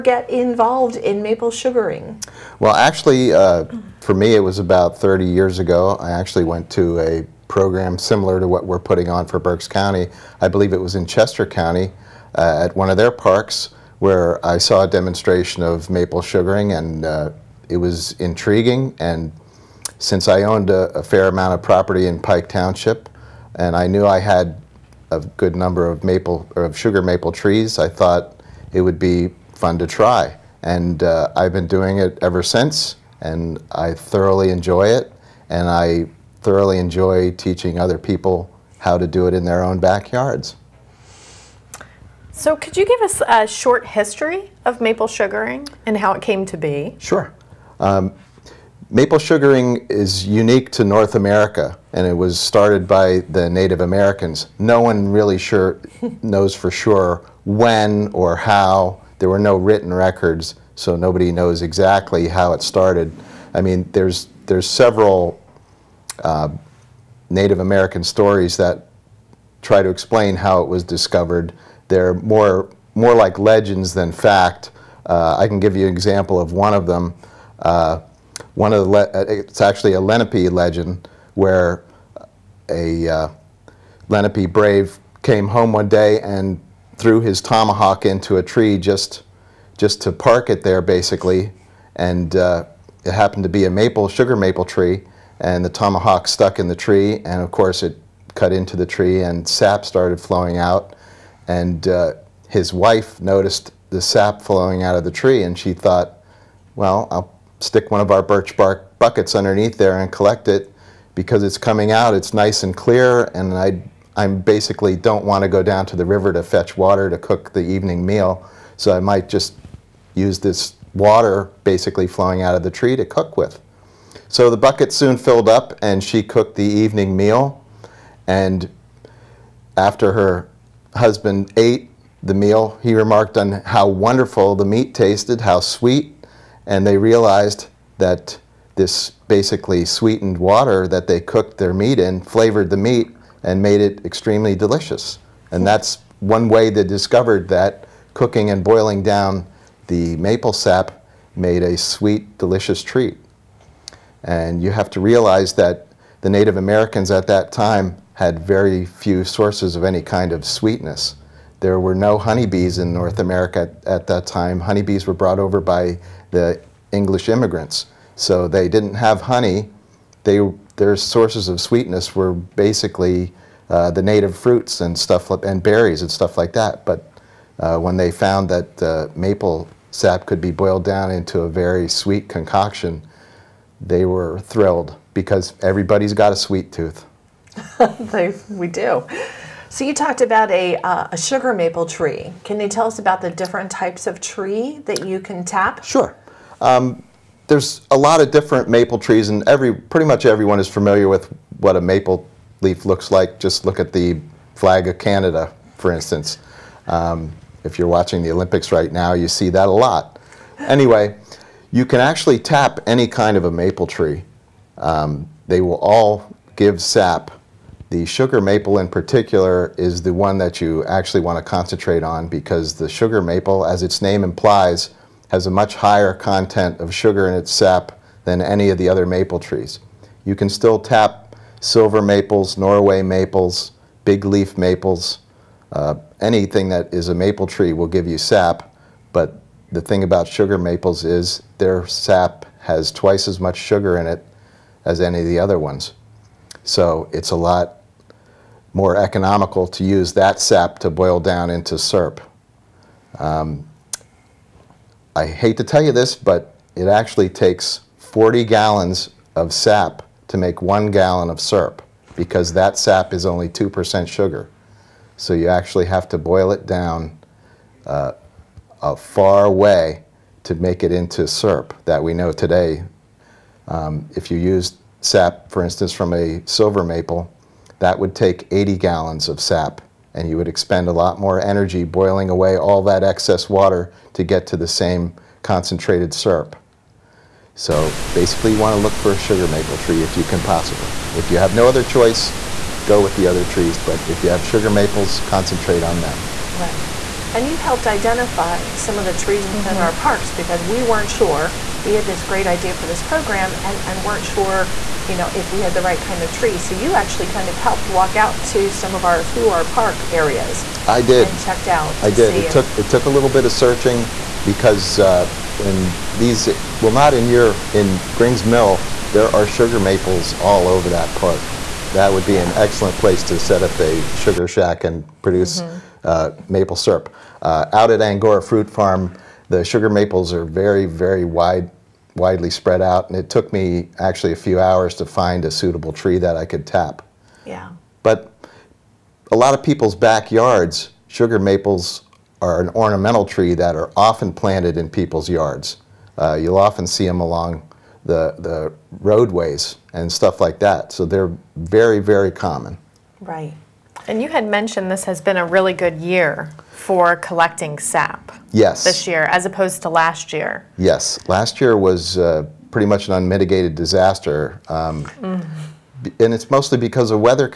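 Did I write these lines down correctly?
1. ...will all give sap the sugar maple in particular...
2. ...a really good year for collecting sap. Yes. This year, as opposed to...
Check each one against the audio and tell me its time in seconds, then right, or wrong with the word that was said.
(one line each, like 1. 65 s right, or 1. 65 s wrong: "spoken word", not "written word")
1. 215 s right
2. 355 s right.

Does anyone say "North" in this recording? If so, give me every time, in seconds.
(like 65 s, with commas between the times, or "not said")
50 s, 162 s.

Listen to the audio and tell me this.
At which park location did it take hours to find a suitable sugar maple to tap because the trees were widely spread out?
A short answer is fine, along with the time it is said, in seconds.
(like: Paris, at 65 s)
Angora Fruit Farm, at 328 s.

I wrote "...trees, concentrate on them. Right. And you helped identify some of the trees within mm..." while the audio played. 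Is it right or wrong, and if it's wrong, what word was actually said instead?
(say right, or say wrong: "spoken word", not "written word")
wrong: "maples", not "trees".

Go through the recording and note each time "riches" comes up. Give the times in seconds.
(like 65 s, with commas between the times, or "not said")
not said.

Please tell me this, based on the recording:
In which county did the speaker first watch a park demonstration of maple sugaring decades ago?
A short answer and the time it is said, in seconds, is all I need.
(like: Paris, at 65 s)
Chester County, at 11 s.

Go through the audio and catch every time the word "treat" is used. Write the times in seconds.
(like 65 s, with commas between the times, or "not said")
152 s.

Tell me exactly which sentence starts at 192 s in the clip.
Can you tell us about the different types of tree that you can tap?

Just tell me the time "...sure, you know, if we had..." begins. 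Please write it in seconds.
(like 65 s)
304 s.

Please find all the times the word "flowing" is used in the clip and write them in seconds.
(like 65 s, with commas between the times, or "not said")
100 s, 104 s, 122 s.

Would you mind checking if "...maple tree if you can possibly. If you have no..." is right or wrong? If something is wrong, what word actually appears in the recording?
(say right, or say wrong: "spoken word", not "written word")
right.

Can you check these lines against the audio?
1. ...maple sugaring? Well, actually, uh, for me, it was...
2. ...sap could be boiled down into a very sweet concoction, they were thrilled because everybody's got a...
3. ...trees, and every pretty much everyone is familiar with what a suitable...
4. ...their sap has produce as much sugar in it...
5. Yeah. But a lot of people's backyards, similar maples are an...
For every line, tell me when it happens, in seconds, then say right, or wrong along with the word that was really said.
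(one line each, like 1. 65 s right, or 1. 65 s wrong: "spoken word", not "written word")
1. 1 s right
2. 179 s right
3. 198 s wrong: "maple", not "suitable"
4. 241 s wrong: "twice", not "produce"
5. 337 s wrong: "sugar", not "similar".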